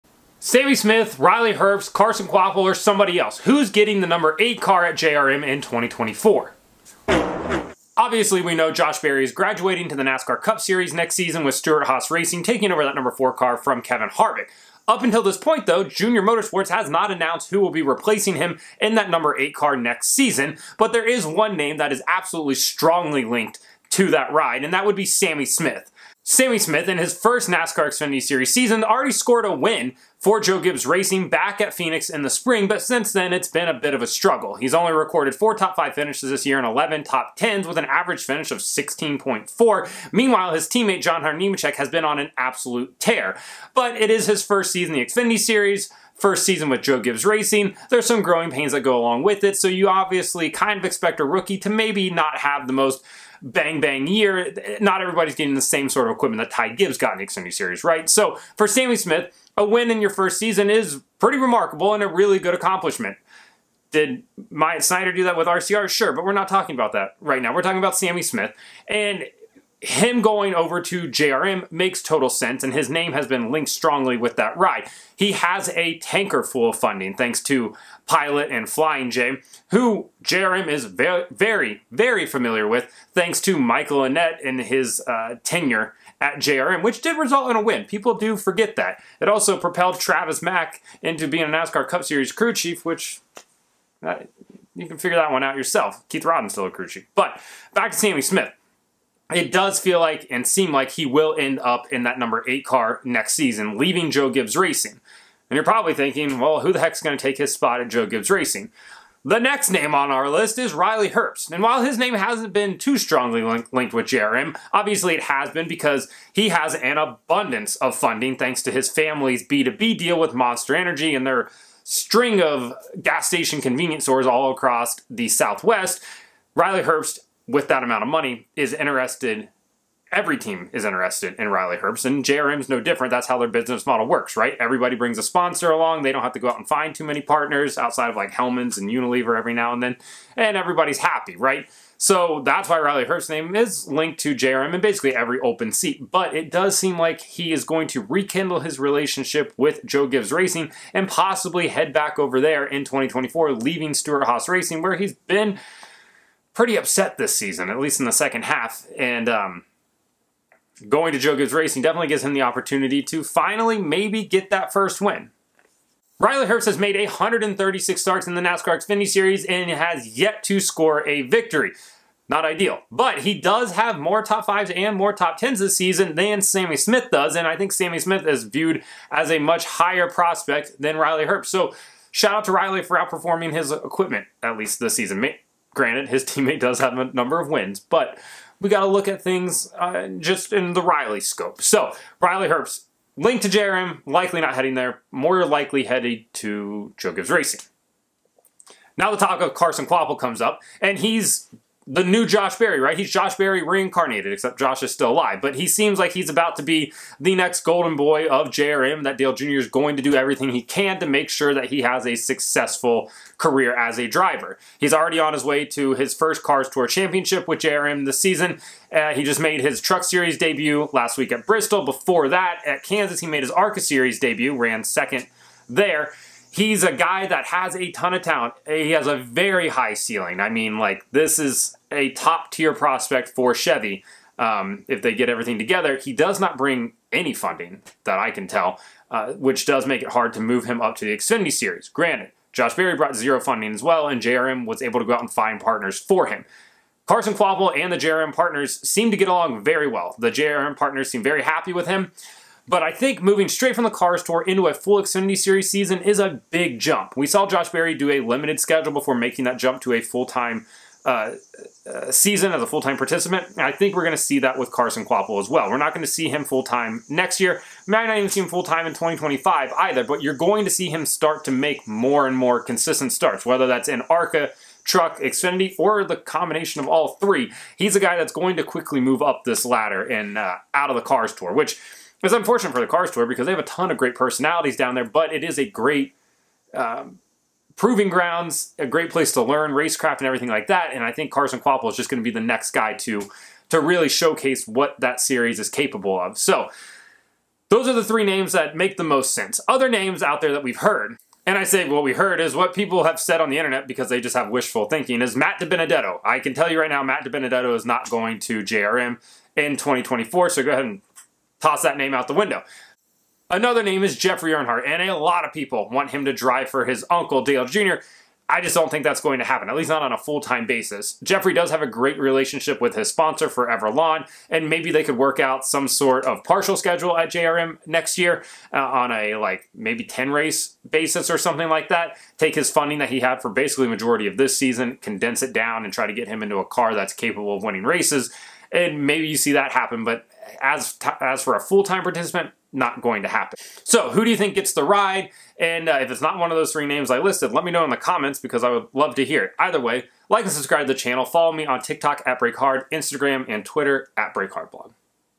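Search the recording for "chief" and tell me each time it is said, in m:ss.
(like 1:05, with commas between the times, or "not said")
1:32, 1:36.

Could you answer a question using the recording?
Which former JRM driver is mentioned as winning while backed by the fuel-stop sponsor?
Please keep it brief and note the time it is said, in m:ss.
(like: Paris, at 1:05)
Michael Annett, at 1:23.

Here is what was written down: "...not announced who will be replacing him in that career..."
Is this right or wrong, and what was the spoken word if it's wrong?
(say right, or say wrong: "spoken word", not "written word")
wrong: "number", not "career".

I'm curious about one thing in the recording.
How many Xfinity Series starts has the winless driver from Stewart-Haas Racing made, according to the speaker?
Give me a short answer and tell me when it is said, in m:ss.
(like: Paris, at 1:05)
136, at 2:46.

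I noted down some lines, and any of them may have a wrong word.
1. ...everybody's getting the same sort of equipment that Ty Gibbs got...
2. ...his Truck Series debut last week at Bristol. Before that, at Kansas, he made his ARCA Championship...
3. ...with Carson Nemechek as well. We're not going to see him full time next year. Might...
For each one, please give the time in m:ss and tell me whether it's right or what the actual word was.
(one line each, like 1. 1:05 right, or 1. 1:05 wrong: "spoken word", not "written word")
1. 0:55 right
2. 3:39 wrong: "Series", not "Championship"
3. 4:24 wrong: "Kvapil", not "Nemechek".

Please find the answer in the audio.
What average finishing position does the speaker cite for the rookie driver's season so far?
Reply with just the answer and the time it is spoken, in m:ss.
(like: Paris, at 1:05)
16.4, at 0:38.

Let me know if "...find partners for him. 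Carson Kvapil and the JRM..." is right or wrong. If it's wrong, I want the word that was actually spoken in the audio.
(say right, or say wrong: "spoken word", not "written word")
right.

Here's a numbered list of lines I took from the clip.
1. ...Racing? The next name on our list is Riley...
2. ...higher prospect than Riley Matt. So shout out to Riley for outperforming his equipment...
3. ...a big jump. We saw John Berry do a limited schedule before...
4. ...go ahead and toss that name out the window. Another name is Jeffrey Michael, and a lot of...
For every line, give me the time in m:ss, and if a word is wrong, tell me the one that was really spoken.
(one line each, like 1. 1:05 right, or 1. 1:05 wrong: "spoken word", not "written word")
1. 1:48 right
2. 2:59 wrong: "Herbst", not "Matt"
3. 4:16 wrong: "Josh", not "John"
4. 5:10 wrong: "Earnhardt", not "Michael".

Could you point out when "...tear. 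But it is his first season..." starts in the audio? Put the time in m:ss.
0:42.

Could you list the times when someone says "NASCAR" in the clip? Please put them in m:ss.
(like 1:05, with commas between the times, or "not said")
0:10, 0:27, 1:31, 2:48.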